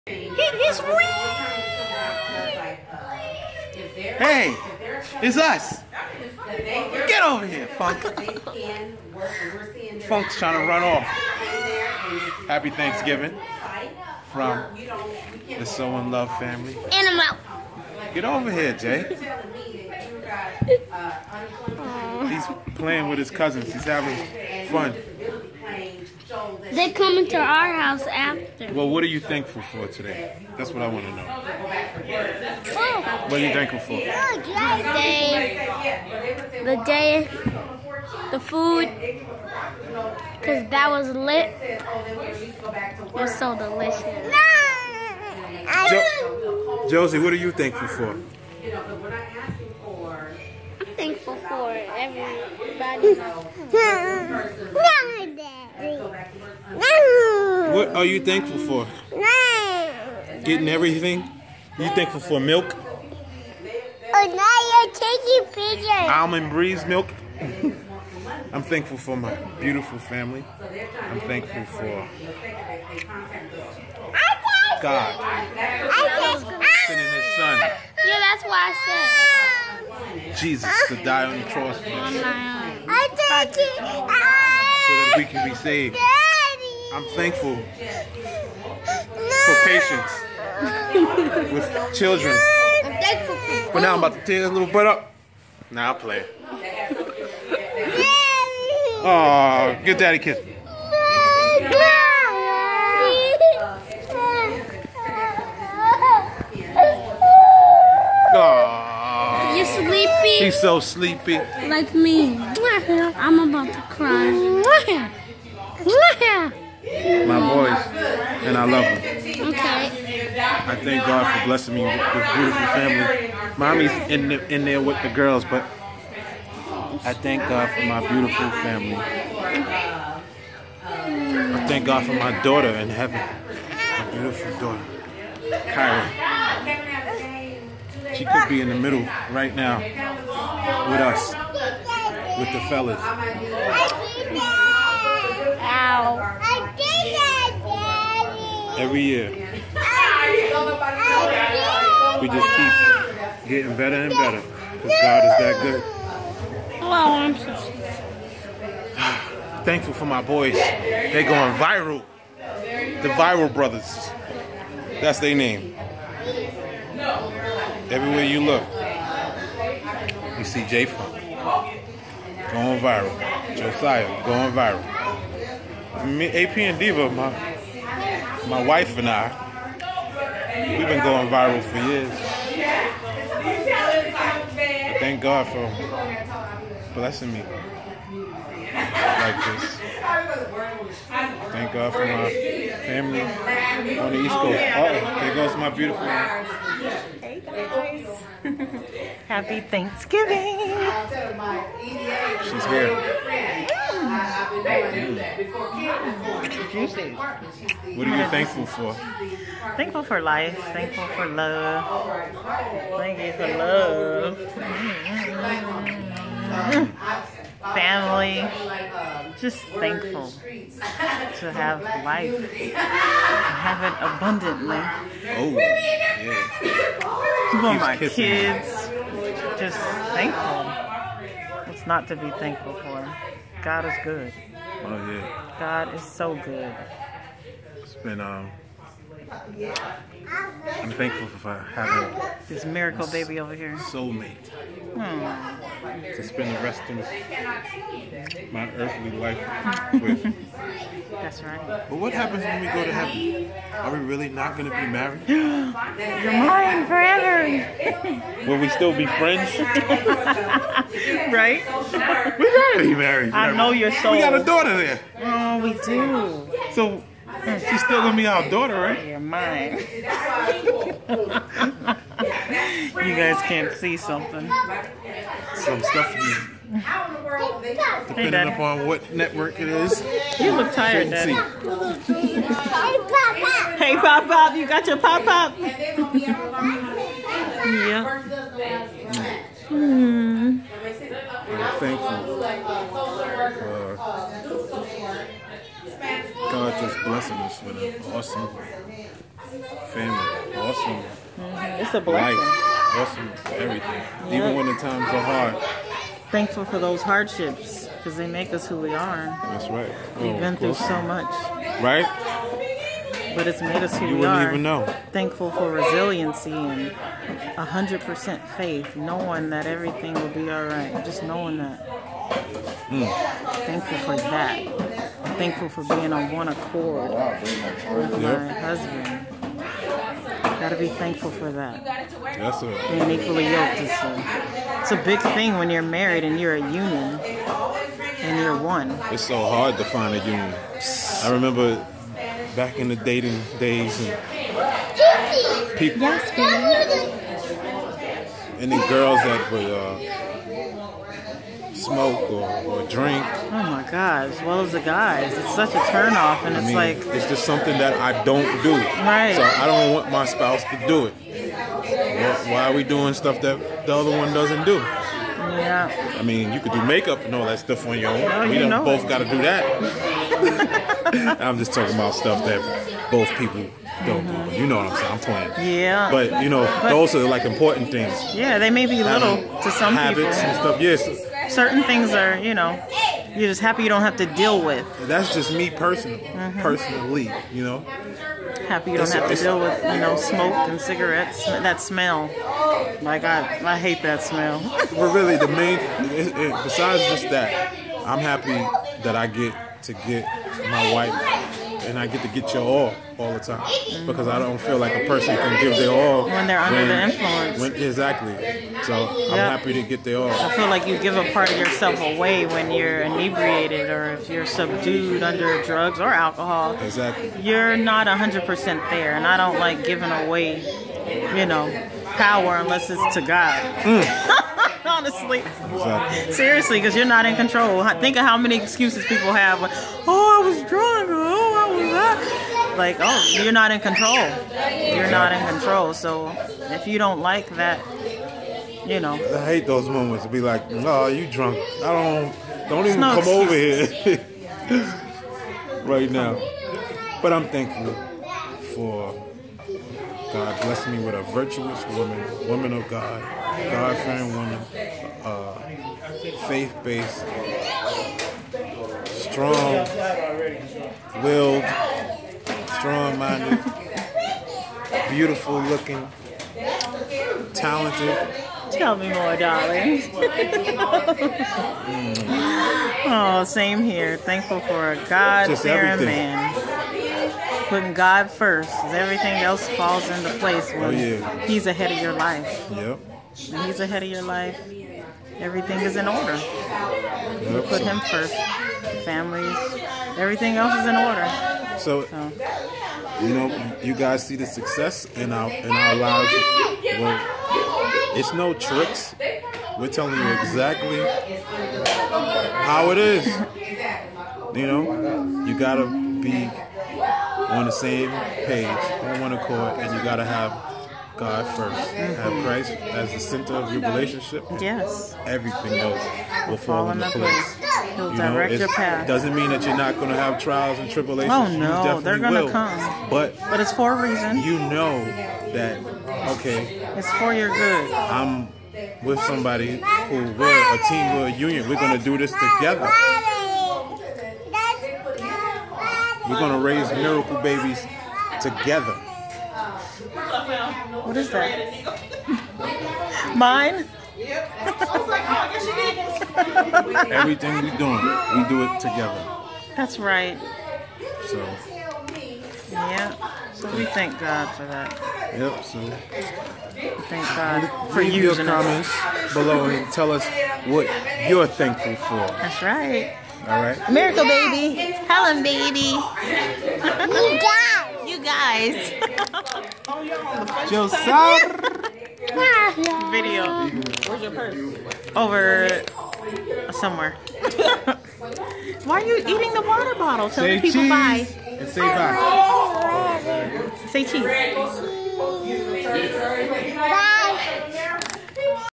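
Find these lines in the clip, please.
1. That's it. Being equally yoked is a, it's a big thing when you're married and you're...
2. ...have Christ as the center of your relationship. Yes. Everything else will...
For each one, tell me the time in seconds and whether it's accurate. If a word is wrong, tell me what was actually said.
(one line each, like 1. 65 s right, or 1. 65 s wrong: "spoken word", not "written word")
1. 331 s right
2. 511 s right.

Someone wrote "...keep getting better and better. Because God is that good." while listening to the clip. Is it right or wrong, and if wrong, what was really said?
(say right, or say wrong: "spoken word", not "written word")
right.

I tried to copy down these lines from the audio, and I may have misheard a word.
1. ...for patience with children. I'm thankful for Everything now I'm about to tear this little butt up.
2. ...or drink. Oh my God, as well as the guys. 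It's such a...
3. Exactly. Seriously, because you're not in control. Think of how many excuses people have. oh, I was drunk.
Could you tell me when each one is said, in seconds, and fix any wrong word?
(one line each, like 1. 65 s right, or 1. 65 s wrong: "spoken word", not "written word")
1. 88 s wrong: "But", not "Everything"
2. 352 s right
3. 425 s right.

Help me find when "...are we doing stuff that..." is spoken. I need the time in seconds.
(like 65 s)
362 s.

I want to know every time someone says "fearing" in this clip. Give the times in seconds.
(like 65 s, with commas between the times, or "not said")
453 s, 475 s.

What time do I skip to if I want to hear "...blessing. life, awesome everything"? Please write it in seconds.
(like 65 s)
302 s.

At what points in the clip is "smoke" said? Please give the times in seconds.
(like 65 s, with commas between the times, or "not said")
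351 s, 390 s.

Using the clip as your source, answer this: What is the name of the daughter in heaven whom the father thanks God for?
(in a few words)
Kyra.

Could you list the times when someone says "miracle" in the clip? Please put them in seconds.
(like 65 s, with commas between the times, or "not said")
242 s, 536 s, 563 s.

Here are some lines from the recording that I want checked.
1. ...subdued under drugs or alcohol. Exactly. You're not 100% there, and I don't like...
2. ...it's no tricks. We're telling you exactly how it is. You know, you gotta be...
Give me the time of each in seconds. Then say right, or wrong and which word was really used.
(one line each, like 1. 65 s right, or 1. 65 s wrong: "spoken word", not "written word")
1. 414 s right
2. 498 s right.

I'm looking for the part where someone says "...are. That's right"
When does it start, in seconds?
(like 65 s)
309 s.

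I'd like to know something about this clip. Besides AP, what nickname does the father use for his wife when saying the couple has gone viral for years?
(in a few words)
Diva.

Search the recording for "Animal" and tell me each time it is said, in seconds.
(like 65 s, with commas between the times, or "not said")
16 s.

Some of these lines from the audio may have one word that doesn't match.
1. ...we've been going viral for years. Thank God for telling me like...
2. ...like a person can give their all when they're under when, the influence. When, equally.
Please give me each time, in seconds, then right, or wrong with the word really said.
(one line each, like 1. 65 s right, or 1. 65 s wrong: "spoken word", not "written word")
1. 180 s wrong: "blessing", not "telling"
2. 404 s wrong: "exactly", not "equally".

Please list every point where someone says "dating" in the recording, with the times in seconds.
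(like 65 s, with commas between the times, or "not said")
342 s.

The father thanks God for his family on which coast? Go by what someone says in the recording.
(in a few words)
East Coast.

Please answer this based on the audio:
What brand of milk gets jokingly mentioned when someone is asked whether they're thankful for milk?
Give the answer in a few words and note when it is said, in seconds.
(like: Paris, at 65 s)
Almond Breeze, at 66 s.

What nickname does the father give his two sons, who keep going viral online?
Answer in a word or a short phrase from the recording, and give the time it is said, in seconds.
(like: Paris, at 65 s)
The Viral Brothers, at 163 s.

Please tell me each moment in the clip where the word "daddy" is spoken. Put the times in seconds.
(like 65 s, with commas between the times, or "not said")
99 s, 281 s.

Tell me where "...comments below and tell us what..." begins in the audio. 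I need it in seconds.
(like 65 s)
558 s.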